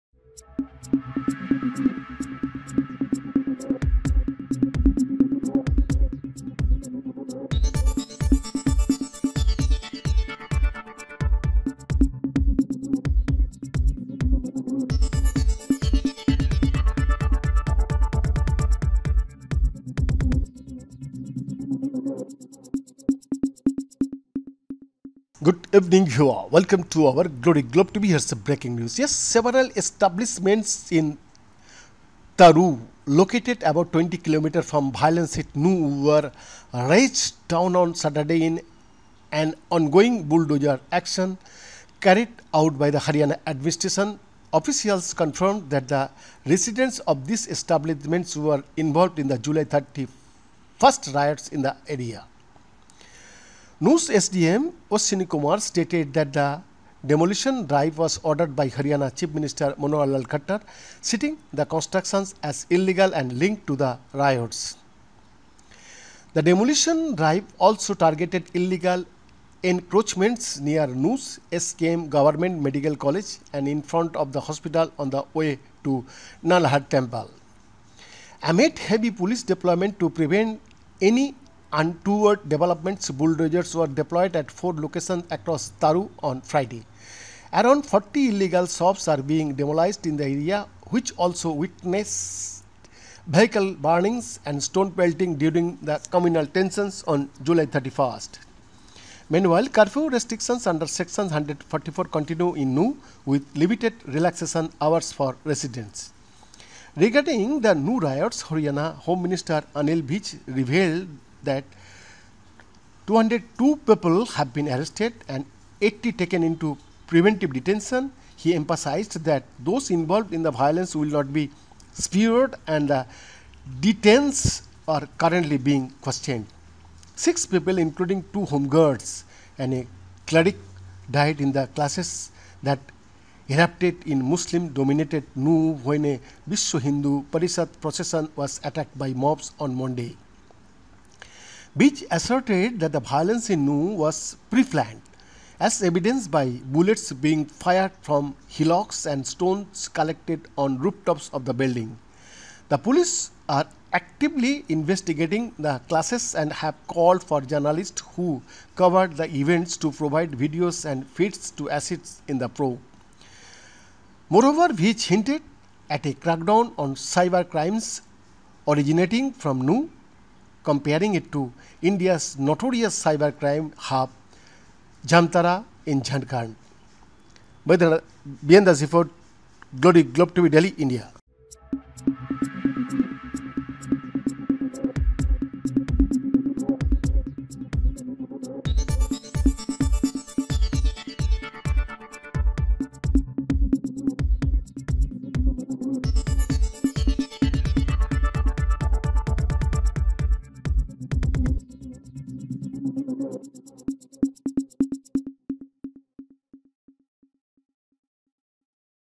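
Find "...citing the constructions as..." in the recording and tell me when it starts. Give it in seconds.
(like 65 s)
61 s.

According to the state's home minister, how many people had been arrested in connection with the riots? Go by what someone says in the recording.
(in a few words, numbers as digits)
202.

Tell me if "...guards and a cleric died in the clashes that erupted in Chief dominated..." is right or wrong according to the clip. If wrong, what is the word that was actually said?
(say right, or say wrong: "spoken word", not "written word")
wrong: "Muslim", not "Chief".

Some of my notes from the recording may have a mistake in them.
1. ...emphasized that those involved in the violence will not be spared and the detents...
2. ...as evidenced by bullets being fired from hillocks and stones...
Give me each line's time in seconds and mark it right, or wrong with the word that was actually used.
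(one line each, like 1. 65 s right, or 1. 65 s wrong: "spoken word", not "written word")
1. 118 s right
2. 145 s right.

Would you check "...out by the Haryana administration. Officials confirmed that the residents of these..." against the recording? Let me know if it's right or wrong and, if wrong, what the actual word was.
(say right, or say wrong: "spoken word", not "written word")
right.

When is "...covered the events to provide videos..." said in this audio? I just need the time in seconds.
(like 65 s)
158 s.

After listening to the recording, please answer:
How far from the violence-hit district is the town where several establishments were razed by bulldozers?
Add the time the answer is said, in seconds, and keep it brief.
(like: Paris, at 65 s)
20 kilometers, at 33 s.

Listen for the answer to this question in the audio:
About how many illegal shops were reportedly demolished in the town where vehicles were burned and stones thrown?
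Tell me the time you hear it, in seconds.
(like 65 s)
87 s.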